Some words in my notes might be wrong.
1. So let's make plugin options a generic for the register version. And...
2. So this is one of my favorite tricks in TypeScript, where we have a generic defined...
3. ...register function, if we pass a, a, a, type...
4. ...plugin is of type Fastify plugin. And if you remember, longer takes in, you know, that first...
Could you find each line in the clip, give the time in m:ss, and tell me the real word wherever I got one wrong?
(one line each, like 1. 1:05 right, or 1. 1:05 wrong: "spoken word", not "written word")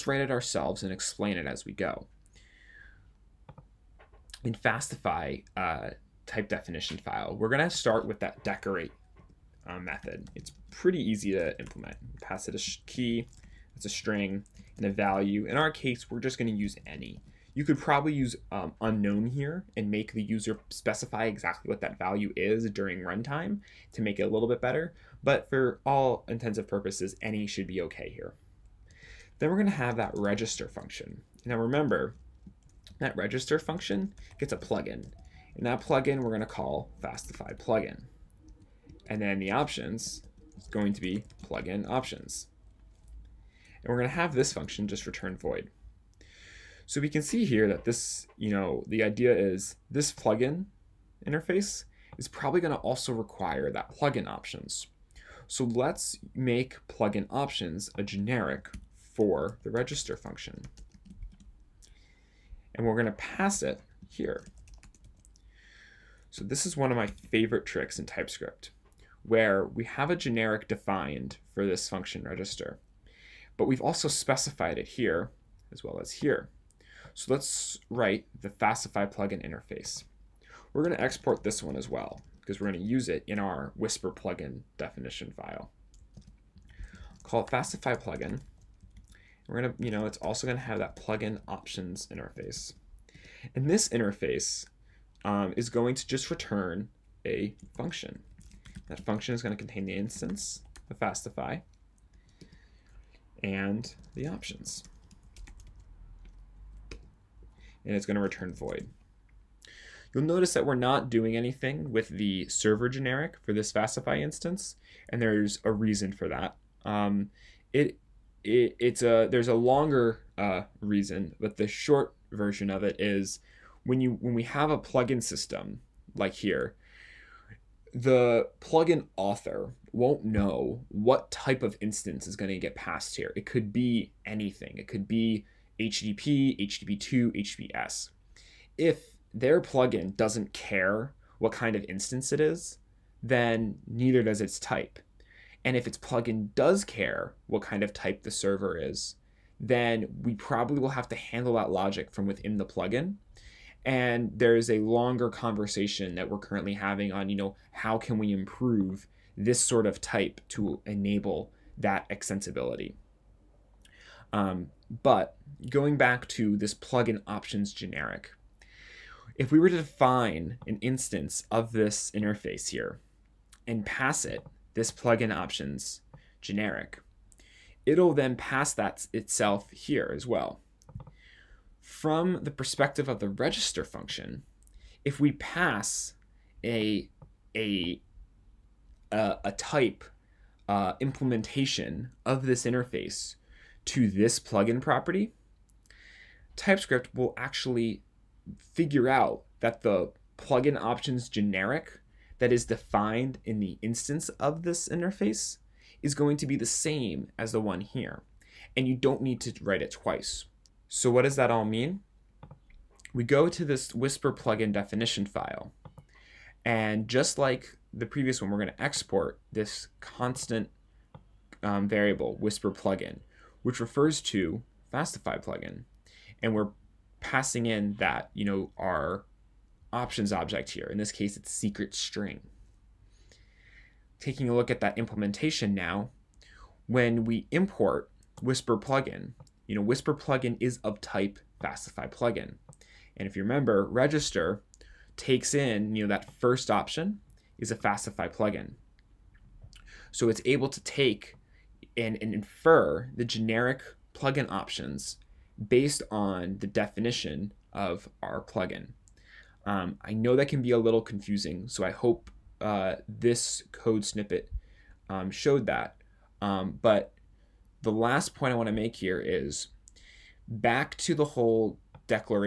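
1. 0:55 wrong: "function", not "version"
2. 1:06 right
3. 3:03 right
4. 4:00 wrong: "register", not "longer".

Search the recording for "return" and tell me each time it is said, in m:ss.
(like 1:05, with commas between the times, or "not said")
0:45, 1:36, 1:48.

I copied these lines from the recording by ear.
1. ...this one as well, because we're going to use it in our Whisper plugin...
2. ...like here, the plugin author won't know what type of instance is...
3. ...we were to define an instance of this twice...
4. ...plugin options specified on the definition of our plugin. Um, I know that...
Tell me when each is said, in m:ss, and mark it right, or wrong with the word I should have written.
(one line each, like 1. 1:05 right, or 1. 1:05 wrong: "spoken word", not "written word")
1. 1:21 right
2. 2:06 right
3. 2:49 wrong: "interface", not "twice"
4. 4:14 wrong: "based", not "specified".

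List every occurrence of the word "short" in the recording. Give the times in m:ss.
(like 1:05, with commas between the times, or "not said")
2:01.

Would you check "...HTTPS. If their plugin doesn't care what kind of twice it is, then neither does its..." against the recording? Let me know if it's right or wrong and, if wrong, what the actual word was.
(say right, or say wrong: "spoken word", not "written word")
wrong: "instance", not "twice".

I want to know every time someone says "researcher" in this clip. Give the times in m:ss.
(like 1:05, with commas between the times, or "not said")
not said.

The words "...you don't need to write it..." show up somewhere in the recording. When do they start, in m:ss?
3:28.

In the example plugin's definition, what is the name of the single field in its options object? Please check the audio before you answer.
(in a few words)
secret.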